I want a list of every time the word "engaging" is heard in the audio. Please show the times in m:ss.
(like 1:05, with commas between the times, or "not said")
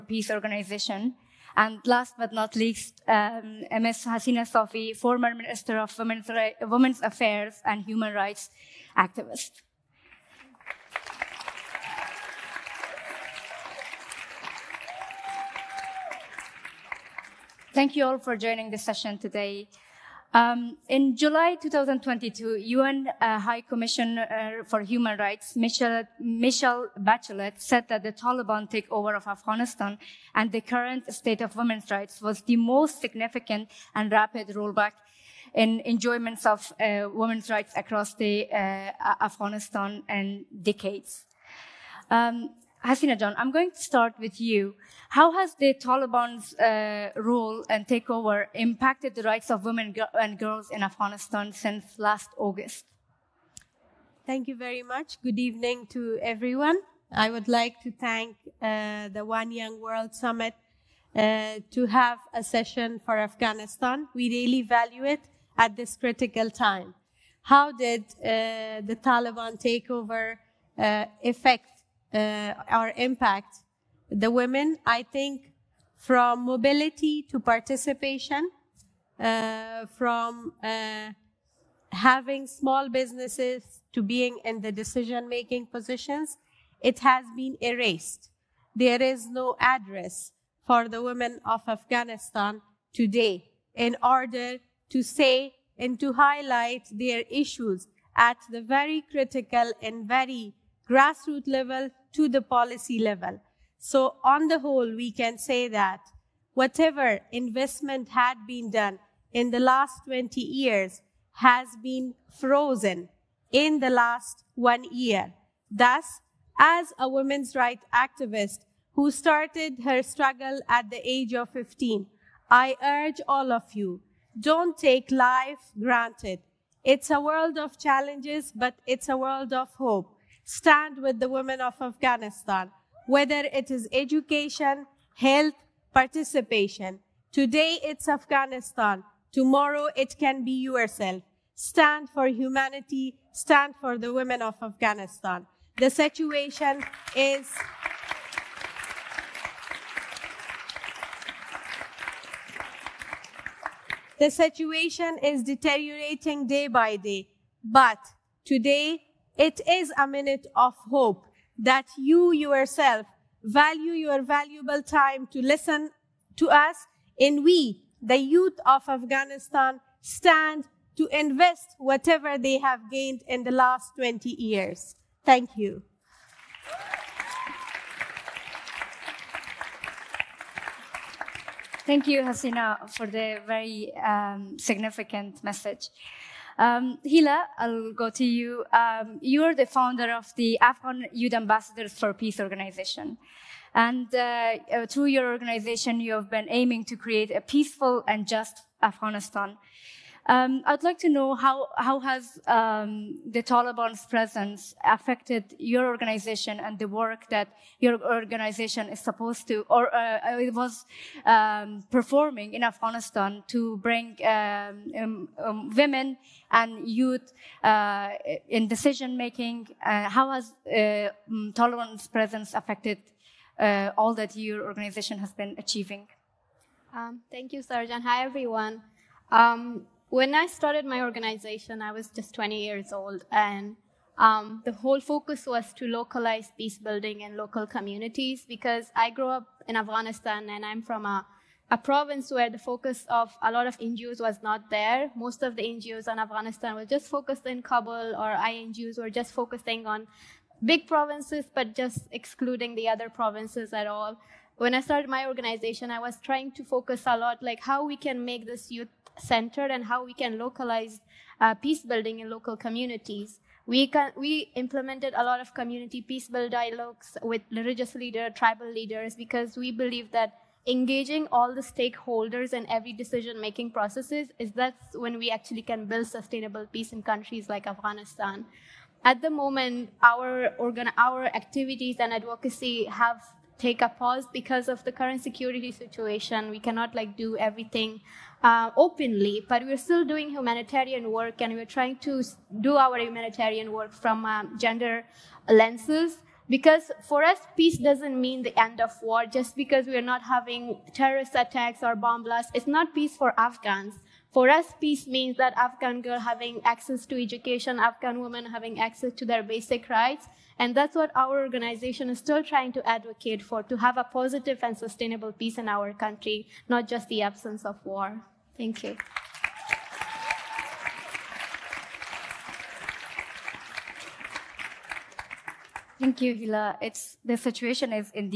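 4:30.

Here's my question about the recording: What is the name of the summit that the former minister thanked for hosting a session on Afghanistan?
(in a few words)
One Young World Summit.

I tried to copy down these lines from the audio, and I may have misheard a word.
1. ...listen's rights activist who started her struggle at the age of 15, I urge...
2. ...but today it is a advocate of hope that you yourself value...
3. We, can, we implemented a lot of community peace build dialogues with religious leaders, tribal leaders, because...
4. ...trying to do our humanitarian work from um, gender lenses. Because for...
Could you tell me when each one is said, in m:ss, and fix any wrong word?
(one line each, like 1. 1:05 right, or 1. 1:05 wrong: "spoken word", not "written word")
1. 1:57 wrong: "women", not "listen"
2. 2:37 wrong: "minute", not "advocate"
3. 4:23 right
4. 4:51 right.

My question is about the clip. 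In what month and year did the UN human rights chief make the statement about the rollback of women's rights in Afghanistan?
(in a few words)
July 2022.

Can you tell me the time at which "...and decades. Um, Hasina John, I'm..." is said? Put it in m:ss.
0:40.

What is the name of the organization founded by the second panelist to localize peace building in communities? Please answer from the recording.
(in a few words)
Afghan Youth Ambassadors for Peace.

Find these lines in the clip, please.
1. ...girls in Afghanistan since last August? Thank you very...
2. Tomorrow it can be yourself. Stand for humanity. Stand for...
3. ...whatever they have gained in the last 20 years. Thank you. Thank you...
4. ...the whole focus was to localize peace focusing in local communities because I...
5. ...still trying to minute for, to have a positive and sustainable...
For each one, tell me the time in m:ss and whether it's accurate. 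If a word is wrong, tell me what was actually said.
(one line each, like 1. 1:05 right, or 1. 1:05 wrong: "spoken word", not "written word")
1. 0:50 right
2. 2:19 right
3. 2:51 right
4. 3:54 wrong: "building", not "focusing"
5. 5:12 wrong: "advocate", not "minute".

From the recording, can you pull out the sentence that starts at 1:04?
We really value it at this critical time.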